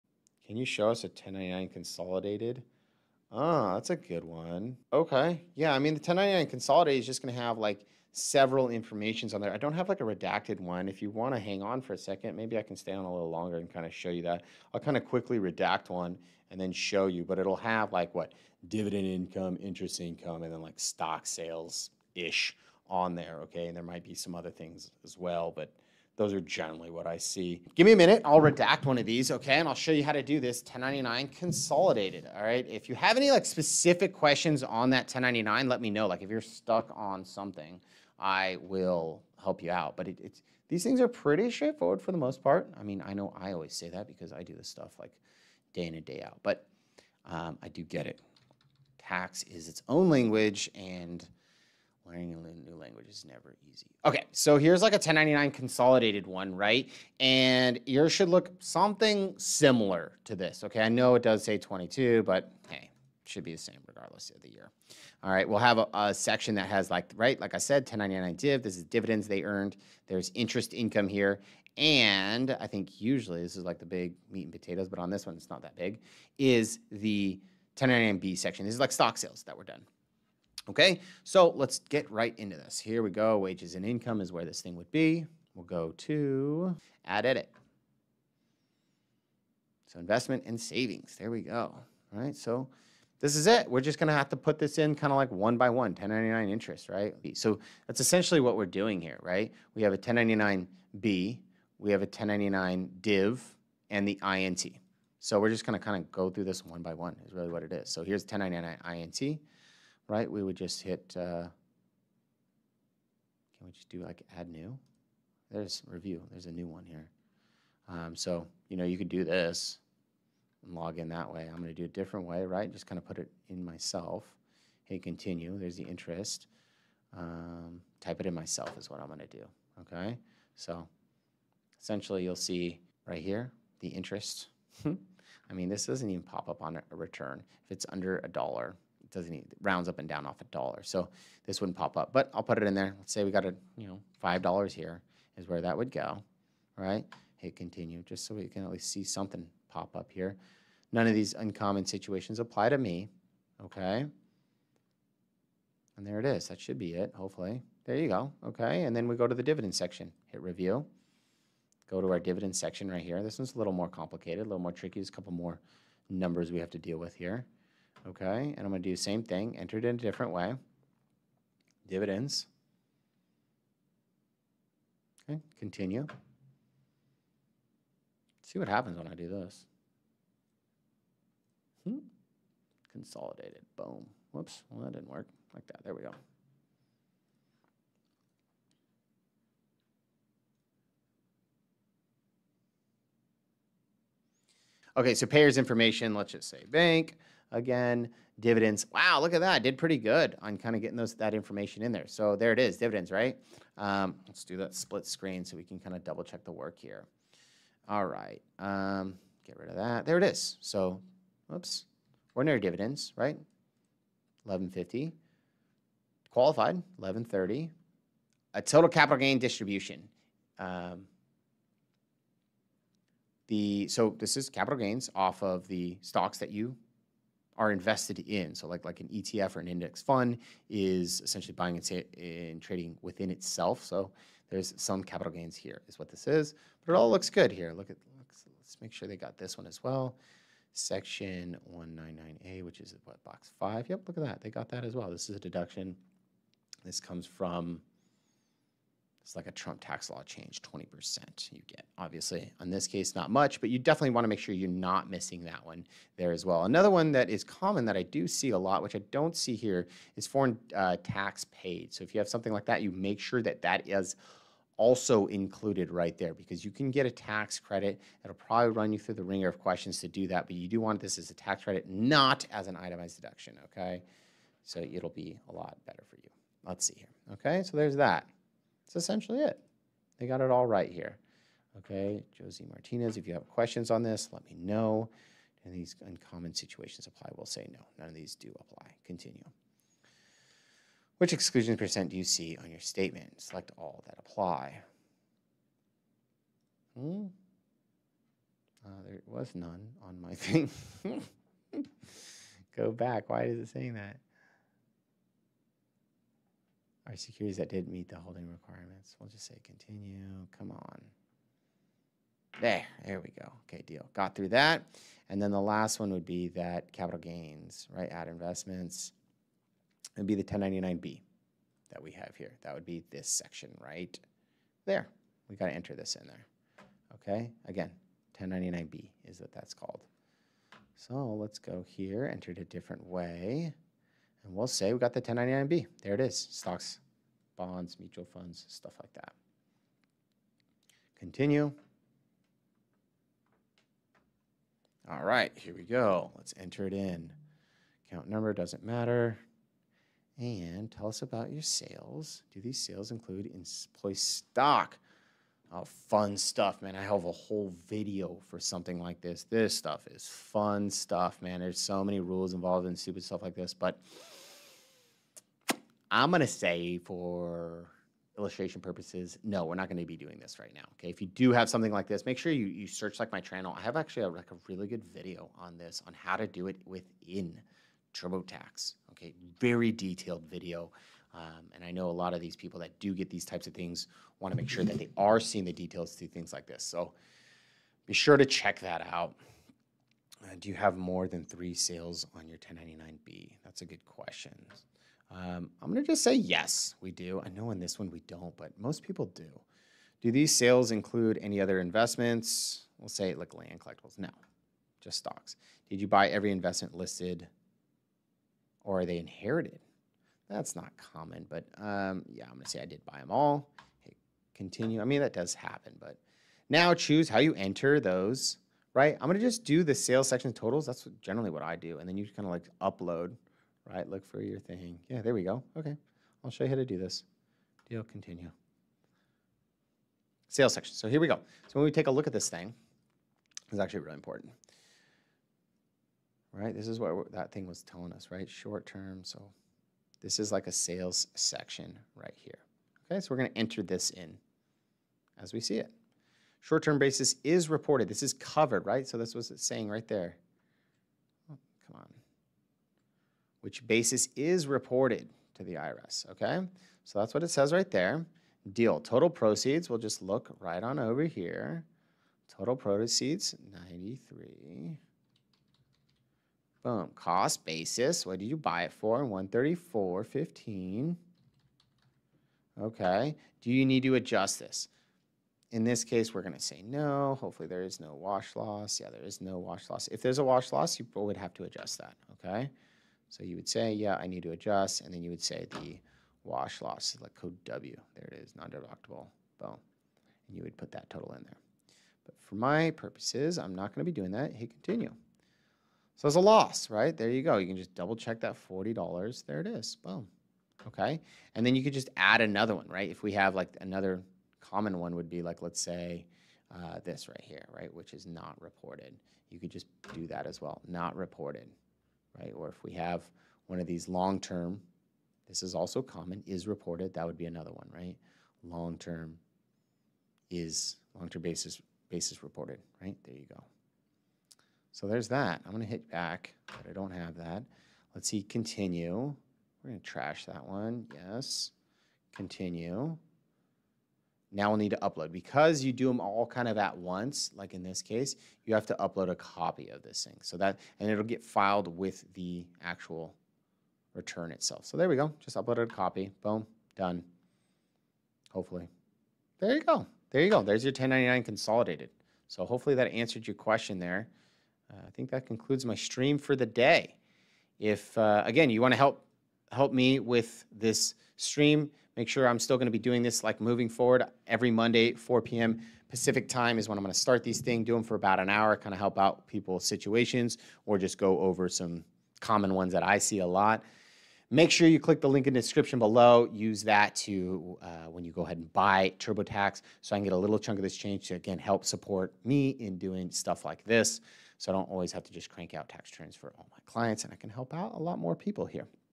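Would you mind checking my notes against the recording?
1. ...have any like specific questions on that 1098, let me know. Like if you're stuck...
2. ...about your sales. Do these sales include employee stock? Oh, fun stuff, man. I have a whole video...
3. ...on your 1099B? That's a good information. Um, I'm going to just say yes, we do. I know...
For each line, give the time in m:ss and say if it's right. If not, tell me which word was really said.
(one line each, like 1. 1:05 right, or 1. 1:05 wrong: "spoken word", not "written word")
1. 0:32 wrong: "1099", not "1098"
2. 5:51 right
3. 6:32 wrong: "question", not "information".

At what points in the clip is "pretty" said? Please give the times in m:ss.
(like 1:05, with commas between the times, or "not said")
0:41, 3:19.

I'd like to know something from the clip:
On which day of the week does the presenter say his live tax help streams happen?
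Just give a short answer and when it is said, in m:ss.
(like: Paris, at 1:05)
Monday, at 9:24.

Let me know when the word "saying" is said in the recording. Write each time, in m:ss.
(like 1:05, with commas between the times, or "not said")
5:03, 7:29.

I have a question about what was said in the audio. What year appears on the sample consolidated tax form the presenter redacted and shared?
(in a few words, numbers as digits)
22.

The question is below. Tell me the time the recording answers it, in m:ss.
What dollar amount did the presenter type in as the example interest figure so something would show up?
2:24.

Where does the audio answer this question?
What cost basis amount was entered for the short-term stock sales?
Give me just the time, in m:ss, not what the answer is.
7:49.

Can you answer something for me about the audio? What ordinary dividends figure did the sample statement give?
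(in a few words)
1150.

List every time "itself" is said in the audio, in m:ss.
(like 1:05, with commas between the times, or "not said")
3:53, 9:04.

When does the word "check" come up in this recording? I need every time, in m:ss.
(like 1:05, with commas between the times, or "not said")
3:26, 6:28, 8:18.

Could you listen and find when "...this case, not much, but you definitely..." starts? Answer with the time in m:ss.
4:12.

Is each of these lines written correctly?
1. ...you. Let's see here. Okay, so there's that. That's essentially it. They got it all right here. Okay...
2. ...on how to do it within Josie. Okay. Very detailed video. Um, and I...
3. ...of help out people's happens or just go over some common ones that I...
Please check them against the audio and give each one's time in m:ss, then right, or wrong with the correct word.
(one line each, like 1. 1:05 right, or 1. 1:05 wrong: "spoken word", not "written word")
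1. 4:36 right
2. 6:16 wrong: "TurboTax", not "Josie"
3. 9:28 wrong: "situations", not "happens".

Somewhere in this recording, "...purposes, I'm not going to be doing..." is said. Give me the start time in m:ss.
8:12.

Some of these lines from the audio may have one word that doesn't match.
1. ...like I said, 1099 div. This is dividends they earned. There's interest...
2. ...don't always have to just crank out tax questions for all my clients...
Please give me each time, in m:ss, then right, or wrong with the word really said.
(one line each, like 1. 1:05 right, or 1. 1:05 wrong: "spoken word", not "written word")
1. 1:07 right
2. 9:44 wrong: "returns", not "questions".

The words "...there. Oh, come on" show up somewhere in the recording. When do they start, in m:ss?
7:30.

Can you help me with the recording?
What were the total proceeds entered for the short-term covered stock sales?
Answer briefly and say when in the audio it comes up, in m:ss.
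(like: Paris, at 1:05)
93, at 7:43.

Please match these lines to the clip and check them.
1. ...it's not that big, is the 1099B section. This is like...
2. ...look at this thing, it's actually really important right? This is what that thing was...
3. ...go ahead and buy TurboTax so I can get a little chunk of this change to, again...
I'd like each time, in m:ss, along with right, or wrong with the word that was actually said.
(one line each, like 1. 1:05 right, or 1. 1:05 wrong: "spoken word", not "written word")
1. 1:15 right
2. 7:12 right
3. 9:38 right.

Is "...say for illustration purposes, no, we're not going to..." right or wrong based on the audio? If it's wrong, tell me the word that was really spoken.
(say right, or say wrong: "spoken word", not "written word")
right.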